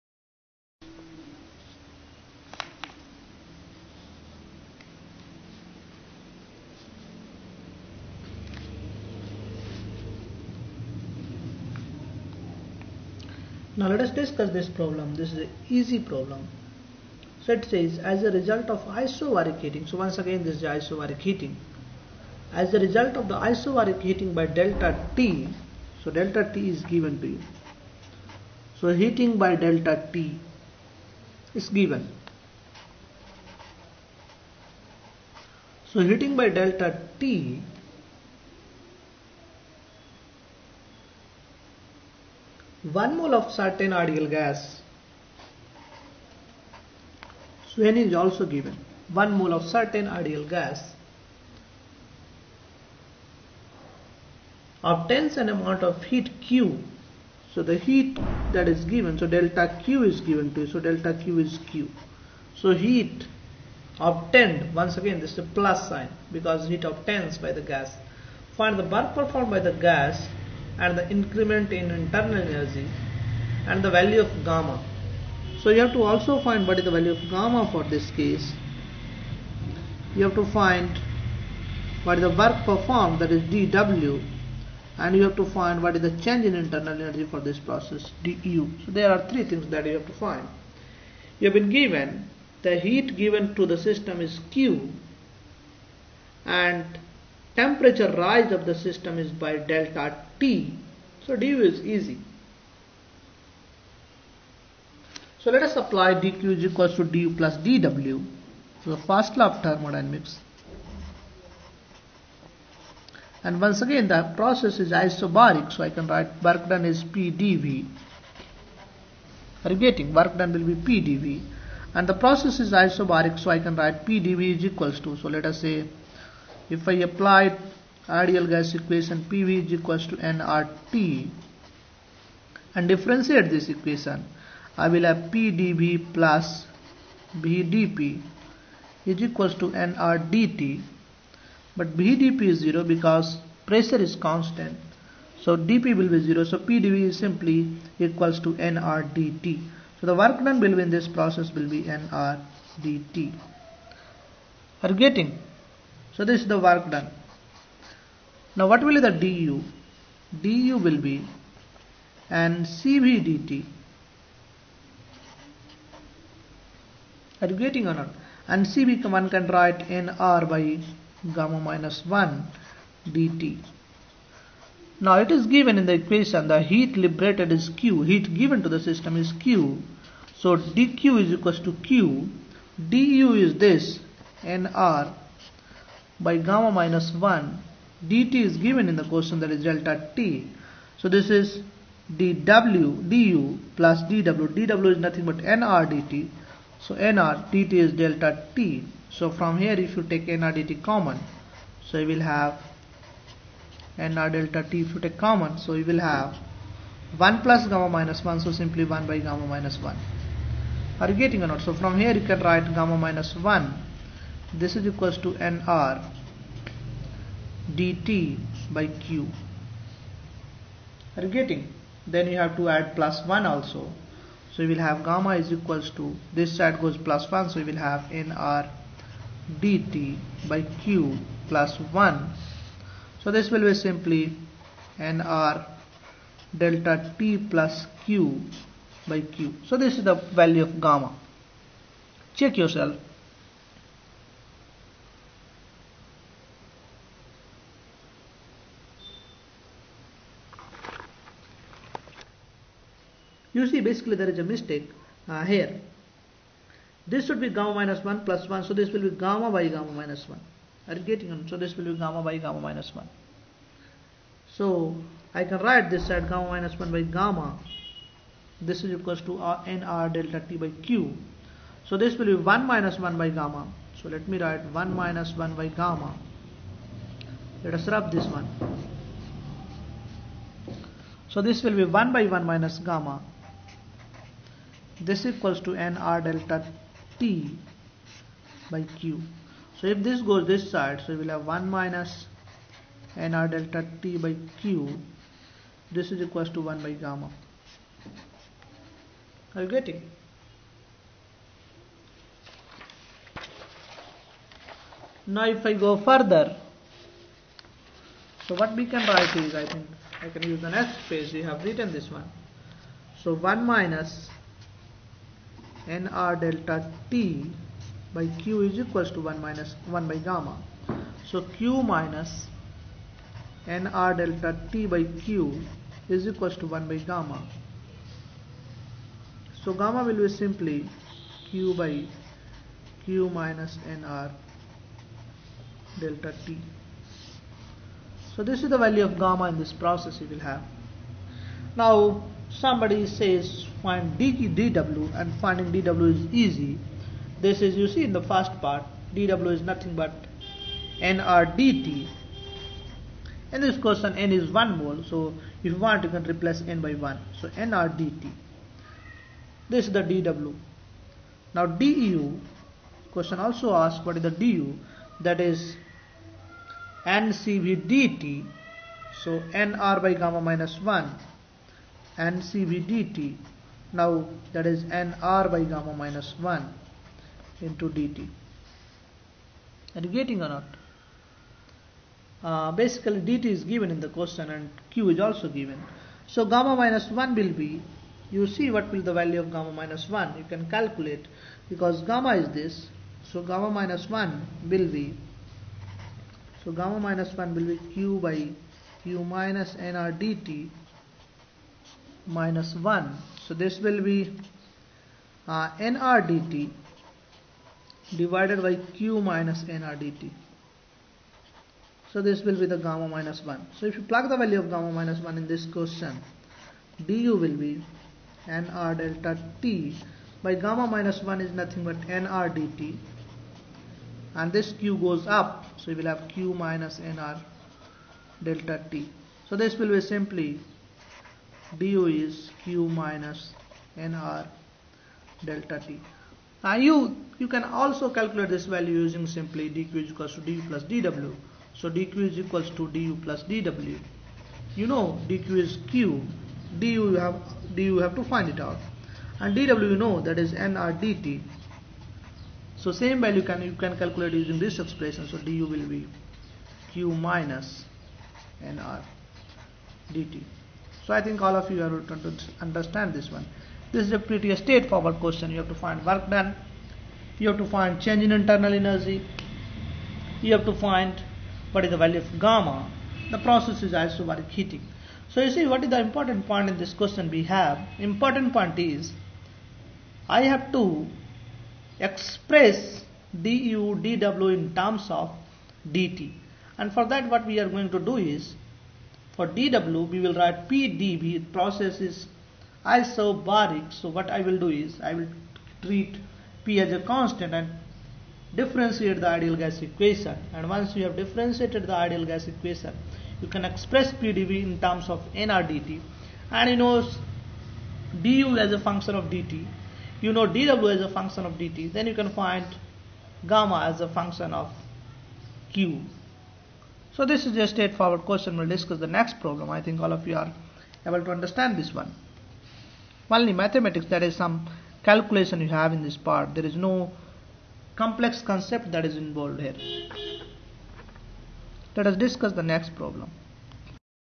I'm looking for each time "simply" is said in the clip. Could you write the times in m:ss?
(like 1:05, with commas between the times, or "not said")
2:27, 3:28, 3:53, 5:30, 7:10, 7:19.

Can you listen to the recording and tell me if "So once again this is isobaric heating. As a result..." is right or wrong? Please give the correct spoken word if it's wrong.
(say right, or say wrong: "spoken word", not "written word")
right.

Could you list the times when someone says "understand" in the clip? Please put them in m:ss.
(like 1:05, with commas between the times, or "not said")
7:42, 8:41.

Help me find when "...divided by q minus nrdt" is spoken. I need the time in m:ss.
6:48.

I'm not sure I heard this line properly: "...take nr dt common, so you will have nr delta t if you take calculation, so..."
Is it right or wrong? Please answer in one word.
wrong.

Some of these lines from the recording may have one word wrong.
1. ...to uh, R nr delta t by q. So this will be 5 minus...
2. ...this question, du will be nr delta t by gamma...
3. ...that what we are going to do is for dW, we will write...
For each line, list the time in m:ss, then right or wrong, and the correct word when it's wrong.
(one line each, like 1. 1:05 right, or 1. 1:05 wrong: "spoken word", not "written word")
1. 4:29 wrong: "1", not "5"
2. 6:55 right
3. 8:07 right.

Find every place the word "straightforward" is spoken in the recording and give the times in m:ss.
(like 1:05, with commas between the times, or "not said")
7:44, 8:37.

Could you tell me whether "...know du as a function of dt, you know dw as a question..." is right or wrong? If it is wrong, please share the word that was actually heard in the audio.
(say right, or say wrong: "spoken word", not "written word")
wrong: "function", not "question".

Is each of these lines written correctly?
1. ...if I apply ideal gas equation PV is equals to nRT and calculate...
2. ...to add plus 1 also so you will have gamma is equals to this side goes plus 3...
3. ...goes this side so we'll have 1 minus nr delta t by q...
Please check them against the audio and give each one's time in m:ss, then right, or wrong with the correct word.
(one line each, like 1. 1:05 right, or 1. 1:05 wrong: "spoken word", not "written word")
1. 2:06 wrong: "differentiate", not "calculate"
2. 3:42 wrong: "1", not "3"
3. 4:50 right.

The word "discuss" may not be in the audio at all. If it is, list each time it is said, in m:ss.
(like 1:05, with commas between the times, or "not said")
0:14, 8:38, 8:52.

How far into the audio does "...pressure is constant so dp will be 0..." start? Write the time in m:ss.
2:23.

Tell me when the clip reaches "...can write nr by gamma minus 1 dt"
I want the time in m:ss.
2:49.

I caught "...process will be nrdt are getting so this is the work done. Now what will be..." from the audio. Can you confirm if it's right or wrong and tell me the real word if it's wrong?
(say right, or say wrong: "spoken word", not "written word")
right.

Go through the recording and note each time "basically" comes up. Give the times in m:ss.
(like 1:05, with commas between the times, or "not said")
4:13, 6:22.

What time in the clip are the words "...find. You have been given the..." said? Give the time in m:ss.
1:30.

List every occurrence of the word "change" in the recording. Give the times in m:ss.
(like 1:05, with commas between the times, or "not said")
1:26, 7:48.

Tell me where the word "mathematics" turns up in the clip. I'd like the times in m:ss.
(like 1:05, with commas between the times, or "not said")
8:43.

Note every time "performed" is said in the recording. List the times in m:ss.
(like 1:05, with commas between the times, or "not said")
1:09, 1:22.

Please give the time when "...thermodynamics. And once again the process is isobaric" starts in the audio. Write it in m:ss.
1:49.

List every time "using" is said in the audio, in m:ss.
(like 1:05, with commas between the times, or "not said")
7:18, 7:34.